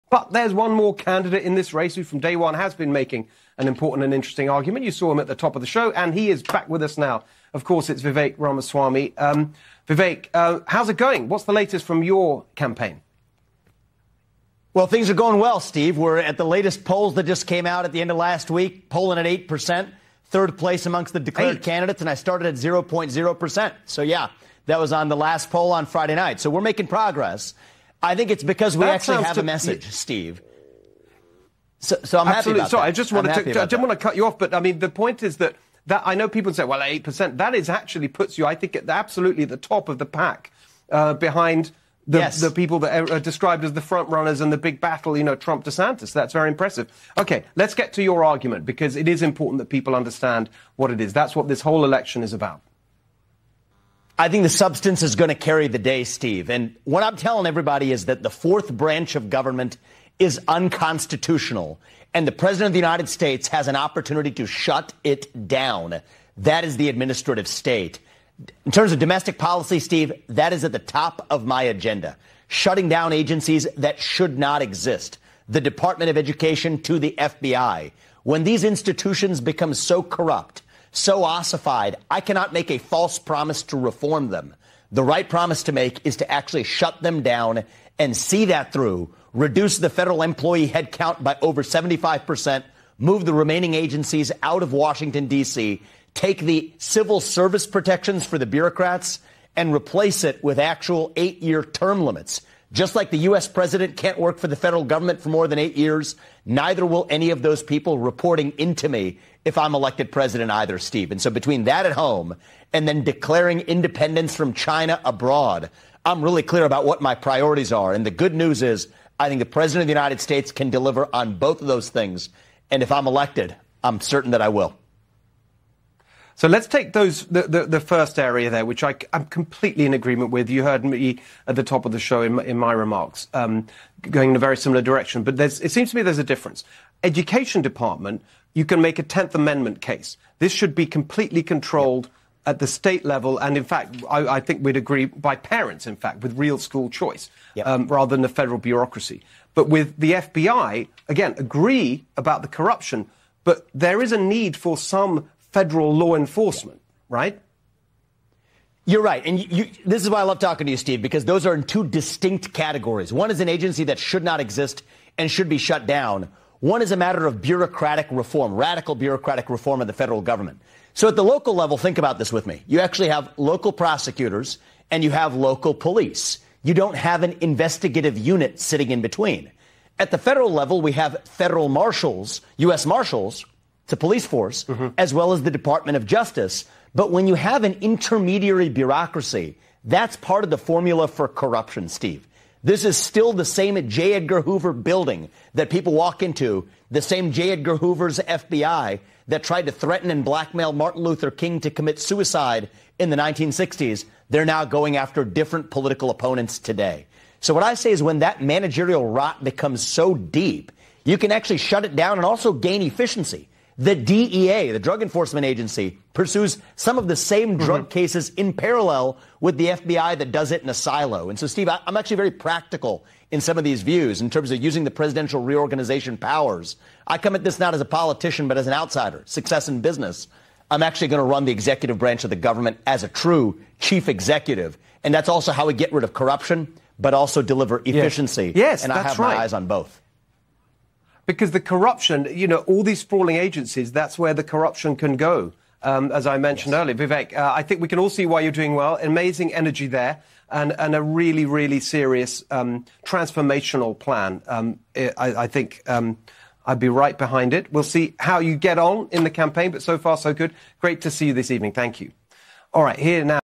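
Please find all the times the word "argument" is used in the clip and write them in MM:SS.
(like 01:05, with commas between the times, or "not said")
00:04, 00:48.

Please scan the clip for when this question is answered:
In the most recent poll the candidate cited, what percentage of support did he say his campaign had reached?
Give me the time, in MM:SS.
00:18.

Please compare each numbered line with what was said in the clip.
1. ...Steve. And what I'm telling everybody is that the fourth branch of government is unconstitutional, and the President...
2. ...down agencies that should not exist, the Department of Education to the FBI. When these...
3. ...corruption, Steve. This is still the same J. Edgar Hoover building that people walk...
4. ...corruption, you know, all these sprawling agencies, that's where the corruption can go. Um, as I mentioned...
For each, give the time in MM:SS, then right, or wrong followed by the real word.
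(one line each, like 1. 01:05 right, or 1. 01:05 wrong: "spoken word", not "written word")
1. 00:56 right
2. 01:12 right
3. 03:11 right
4. 04:01 right.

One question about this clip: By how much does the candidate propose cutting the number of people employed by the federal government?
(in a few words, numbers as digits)
over 75%.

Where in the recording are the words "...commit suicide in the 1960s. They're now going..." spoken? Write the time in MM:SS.
03:21.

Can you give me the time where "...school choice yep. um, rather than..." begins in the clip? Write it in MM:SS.
02:26.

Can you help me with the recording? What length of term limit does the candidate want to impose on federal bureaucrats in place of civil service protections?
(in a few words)
8 years.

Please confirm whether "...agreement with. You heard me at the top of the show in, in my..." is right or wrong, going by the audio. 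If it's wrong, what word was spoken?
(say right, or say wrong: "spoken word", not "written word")
right.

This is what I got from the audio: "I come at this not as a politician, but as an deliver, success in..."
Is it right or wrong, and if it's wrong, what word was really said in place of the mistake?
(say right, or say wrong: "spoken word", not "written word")
wrong: "outsider", not "deliver".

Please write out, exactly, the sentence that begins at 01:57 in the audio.
And the good news is, I think the president of the United States can deliver on both of those things.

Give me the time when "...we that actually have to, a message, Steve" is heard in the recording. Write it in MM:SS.
00:28.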